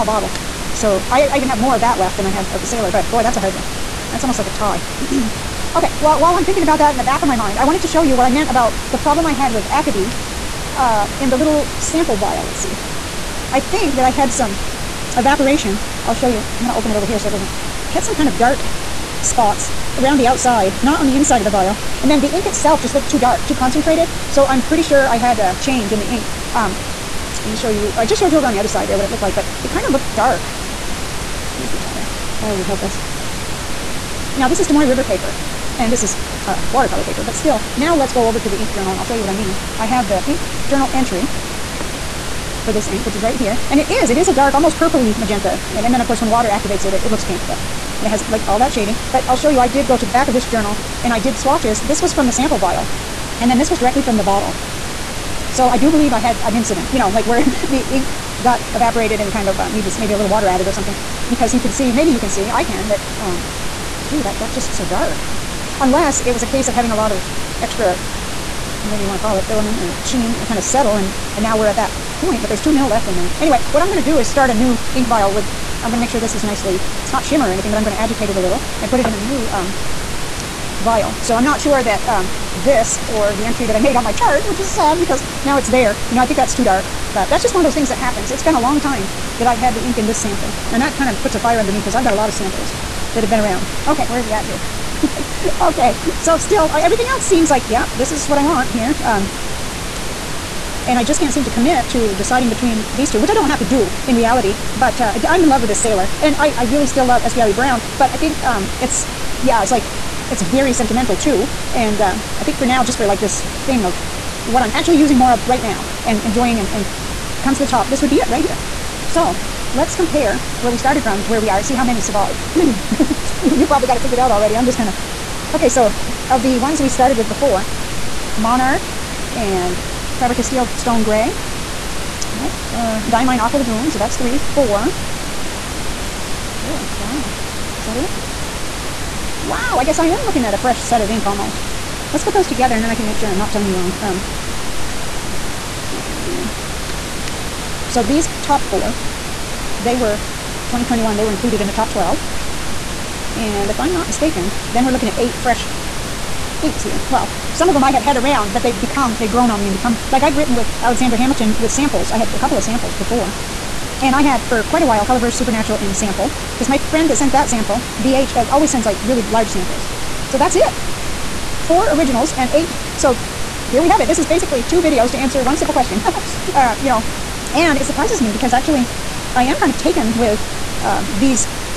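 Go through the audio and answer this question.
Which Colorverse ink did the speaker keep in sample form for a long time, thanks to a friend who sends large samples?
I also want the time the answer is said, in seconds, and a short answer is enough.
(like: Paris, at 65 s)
Supernatural, at 165 s.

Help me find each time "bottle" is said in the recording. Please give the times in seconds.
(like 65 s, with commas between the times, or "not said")
0 s, 54 s.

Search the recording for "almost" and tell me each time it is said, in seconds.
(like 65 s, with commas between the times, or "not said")
4 s, 44 s, 141 s.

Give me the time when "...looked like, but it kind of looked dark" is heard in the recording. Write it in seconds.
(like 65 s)
29 s.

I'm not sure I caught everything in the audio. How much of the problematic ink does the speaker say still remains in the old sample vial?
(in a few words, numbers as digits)
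2 mil.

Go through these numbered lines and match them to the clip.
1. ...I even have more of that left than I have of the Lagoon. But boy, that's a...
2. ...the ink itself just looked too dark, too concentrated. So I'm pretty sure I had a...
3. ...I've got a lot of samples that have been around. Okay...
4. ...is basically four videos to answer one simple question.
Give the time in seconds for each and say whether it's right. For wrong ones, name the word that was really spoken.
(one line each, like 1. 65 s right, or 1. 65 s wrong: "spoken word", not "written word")
1. 1 s wrong: "Sailor", not "Lagoon"
2. 22 s right
3. 91 s right
4. 174 s wrong: "two", not "four".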